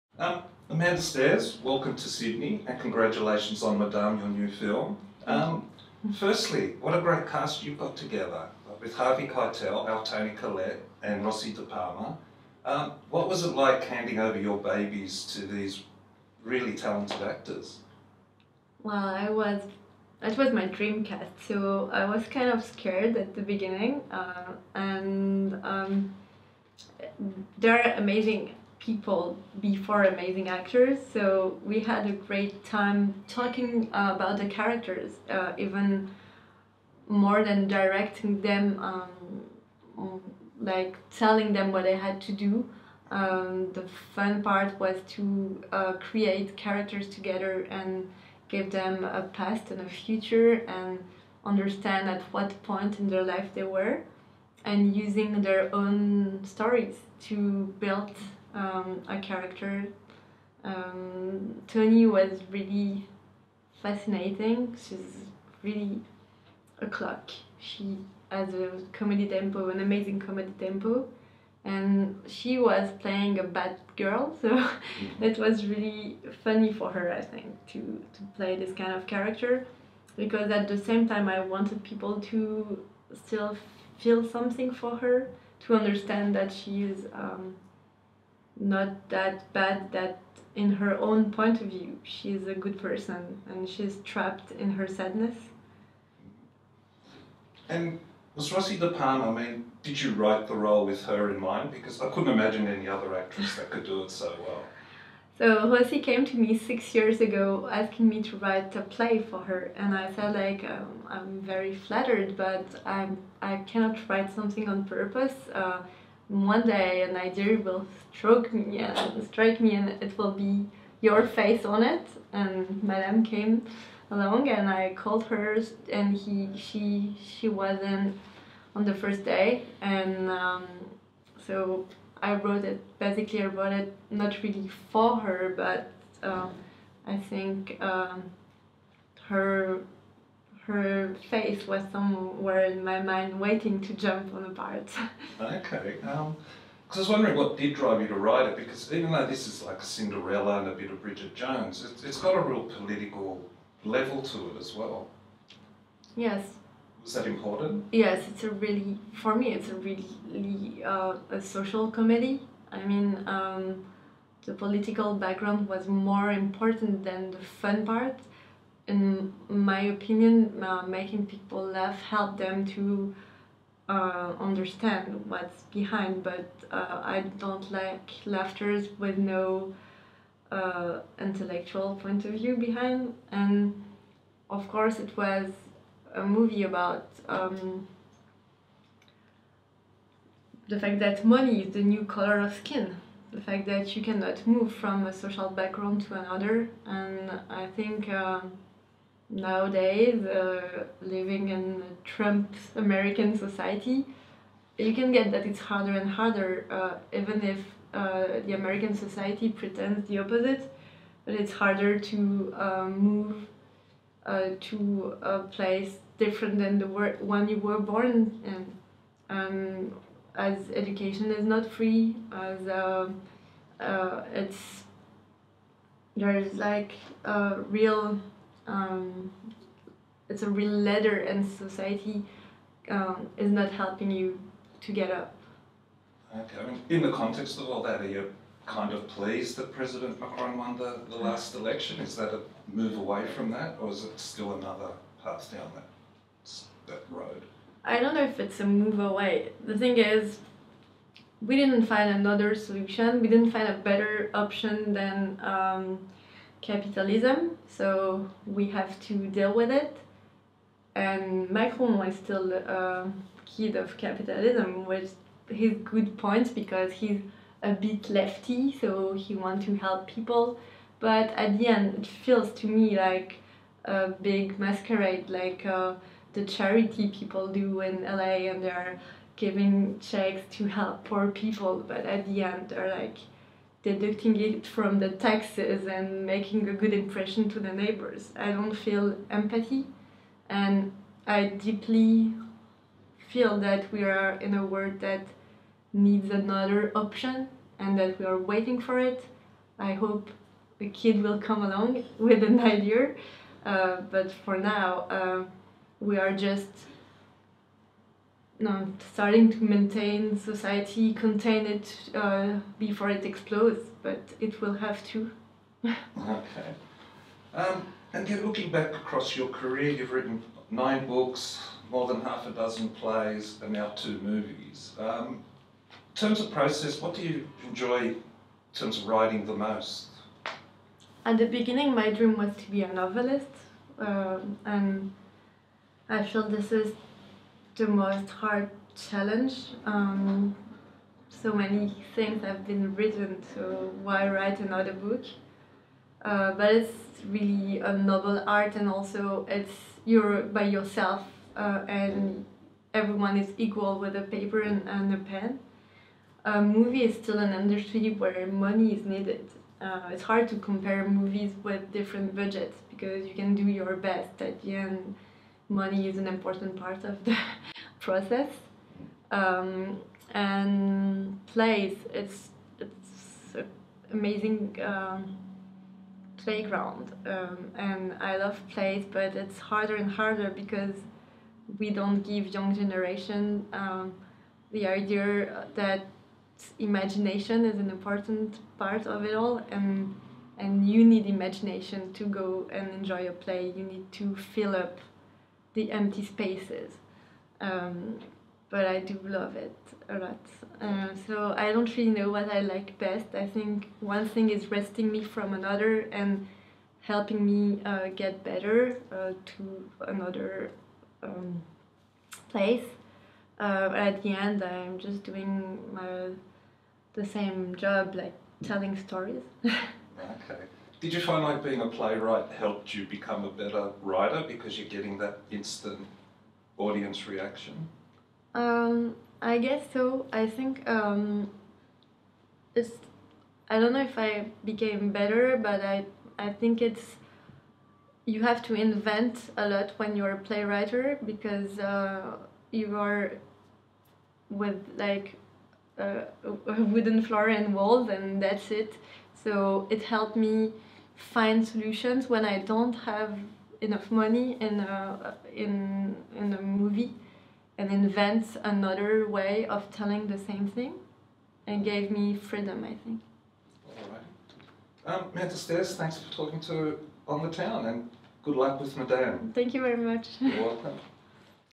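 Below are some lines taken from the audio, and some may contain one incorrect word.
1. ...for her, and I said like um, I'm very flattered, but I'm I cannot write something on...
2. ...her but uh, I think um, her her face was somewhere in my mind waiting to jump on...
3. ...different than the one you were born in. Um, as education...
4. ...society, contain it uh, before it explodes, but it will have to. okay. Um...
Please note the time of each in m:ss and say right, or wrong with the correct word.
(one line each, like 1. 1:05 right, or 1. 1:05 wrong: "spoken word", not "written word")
1. 1:49 right
2. 2:15 right
3. 3:36 right
4. 5:10 right.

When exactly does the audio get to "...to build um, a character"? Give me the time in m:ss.
0:57.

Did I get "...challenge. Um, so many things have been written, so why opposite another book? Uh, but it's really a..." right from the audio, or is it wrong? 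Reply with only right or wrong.
wrong.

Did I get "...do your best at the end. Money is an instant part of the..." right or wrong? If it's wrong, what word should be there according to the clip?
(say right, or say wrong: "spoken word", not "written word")
wrong: "important", not "instant".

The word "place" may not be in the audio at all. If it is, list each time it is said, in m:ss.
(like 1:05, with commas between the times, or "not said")
3:35, 6:52.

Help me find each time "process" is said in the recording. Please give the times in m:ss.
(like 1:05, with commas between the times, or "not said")
5:26, 6:08.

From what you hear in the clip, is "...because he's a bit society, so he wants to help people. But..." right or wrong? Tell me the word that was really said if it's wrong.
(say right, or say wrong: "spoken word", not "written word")
wrong: "lefty", not "society".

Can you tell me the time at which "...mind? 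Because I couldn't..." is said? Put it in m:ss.
1:41.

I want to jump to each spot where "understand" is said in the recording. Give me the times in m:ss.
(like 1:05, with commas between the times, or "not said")
0:51, 1:25, 2:54.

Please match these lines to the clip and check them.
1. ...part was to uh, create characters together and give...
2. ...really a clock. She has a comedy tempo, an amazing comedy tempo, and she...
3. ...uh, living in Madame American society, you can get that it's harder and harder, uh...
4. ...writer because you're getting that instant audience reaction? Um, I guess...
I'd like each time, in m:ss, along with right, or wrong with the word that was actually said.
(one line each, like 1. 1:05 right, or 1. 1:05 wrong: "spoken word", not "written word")
1. 0:44 right
2. 1:05 right
3. 3:20 wrong: "Trump", not "Madame"
4. 7:04 right.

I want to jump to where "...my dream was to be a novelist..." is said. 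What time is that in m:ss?
5:31.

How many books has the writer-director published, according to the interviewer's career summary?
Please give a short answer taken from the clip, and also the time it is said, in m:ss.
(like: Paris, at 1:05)
9, at 5:20.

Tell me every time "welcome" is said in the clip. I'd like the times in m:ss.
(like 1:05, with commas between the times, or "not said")
0:01, 7:50.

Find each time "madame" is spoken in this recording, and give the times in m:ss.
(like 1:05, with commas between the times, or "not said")
0:03, 2:02, 7:48.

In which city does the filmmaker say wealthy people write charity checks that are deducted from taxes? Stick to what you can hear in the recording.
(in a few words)
LA.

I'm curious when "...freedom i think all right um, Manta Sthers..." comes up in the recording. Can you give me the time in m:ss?
7:42.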